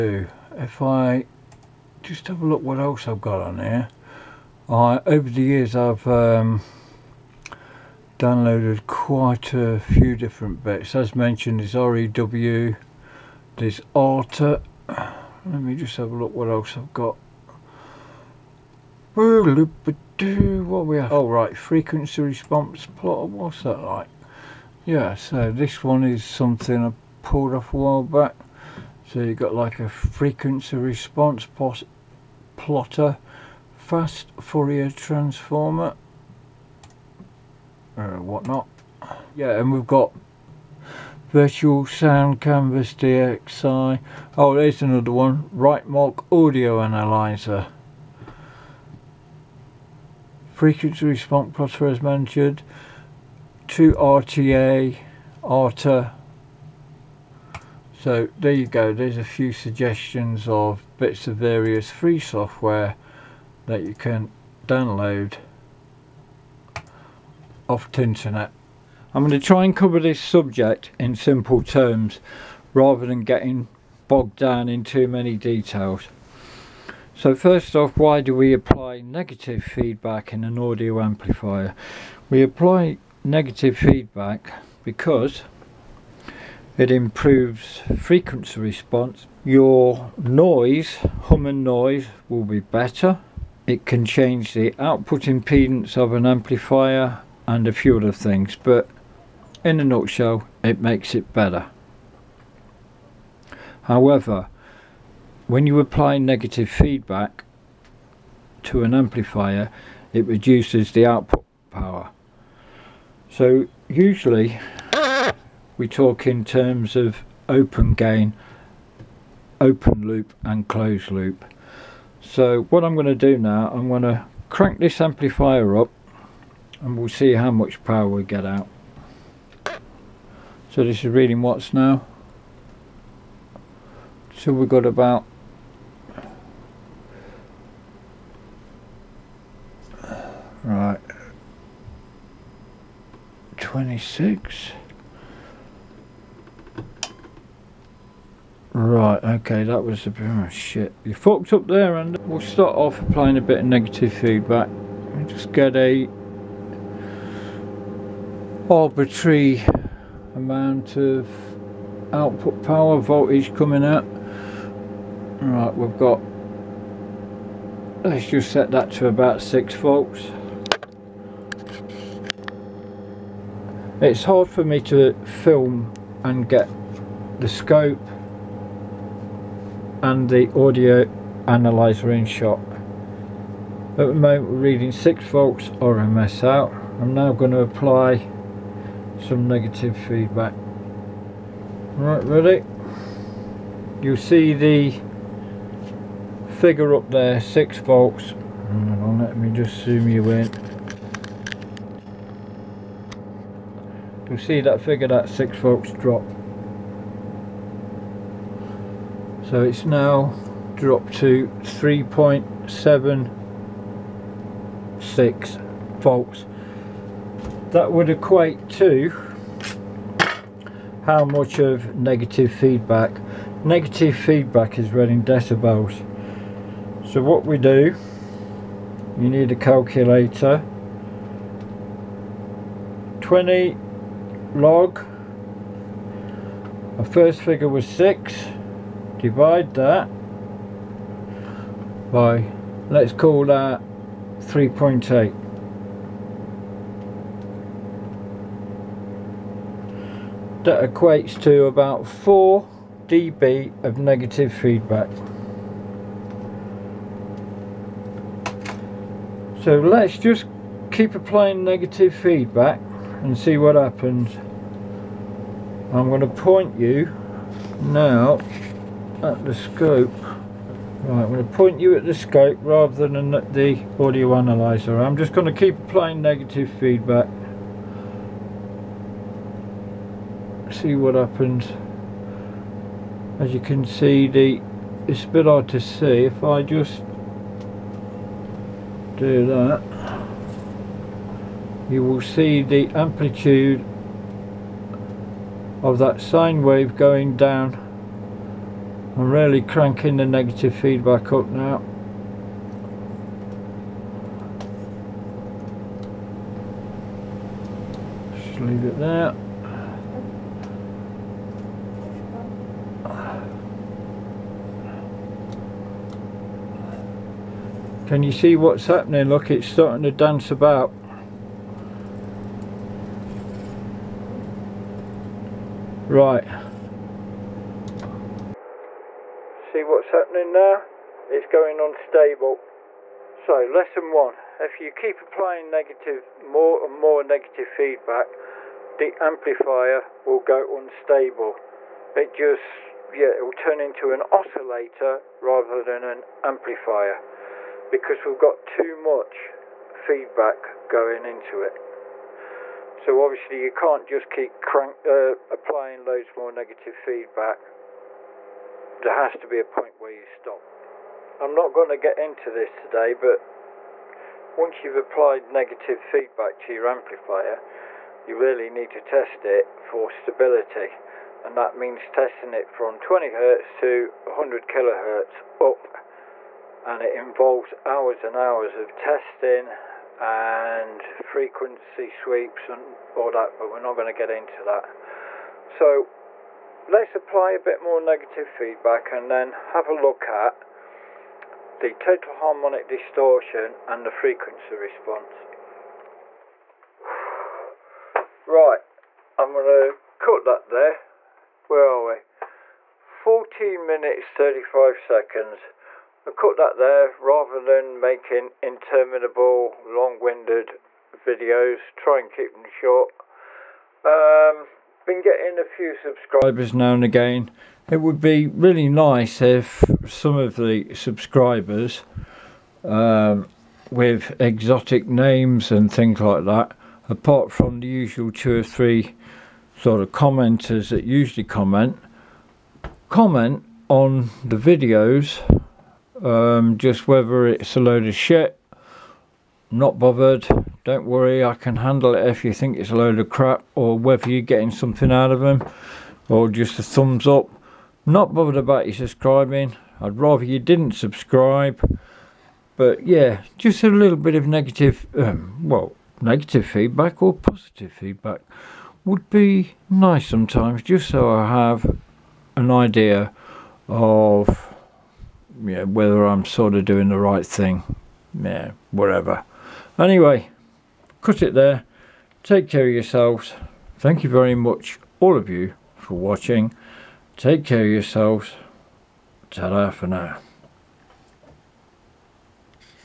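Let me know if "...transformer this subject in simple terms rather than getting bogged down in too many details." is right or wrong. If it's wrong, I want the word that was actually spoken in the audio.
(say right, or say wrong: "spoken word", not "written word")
wrong: "cover", not "transformer".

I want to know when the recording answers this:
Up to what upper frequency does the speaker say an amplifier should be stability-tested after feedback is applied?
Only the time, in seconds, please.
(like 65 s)
374 s.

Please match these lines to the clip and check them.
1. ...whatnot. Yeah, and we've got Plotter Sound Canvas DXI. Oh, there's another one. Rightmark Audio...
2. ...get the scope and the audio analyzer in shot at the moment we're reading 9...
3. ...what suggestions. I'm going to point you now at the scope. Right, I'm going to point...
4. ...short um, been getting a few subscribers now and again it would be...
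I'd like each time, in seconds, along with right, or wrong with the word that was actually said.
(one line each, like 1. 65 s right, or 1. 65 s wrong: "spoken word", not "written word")
1. 38 s wrong: "Virtual", not "Plotter"
2. 176 s wrong: "6", not "9"
3. 263 s wrong: "happens", not "suggestions"
4. 412 s right.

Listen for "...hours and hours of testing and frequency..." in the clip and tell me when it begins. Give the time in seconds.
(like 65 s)
377 s.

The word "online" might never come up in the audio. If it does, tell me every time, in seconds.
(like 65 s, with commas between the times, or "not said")
not said.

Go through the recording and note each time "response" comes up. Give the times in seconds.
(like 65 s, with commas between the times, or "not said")
22 s, 30 s, 51 s, 88 s, 394 s.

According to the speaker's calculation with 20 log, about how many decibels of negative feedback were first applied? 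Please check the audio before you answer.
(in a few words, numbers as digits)
4 dB.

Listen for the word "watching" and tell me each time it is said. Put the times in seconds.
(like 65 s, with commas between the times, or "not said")
476 s.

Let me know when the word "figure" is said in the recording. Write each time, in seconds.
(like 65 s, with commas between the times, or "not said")
196 s, 204 s, 237 s.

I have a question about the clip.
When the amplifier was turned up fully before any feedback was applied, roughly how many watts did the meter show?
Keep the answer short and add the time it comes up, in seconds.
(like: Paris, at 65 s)
26, at 143 s.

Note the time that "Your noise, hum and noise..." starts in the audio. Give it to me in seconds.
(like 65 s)
89 s.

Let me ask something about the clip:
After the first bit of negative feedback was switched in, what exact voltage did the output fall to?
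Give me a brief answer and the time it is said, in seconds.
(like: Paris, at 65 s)
3.76 volts, at 211 s.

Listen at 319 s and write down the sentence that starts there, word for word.
Look, it's starting to dance about.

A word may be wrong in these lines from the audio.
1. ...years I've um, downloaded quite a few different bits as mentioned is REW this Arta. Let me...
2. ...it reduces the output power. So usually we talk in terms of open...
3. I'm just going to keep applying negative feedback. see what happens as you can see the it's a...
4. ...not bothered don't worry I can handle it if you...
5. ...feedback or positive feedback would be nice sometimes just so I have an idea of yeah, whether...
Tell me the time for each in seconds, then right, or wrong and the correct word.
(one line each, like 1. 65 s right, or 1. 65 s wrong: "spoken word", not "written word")
1. 5 s right
2. 110 s right
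3. 274 s right
4. 439 s right
5. 456 s right.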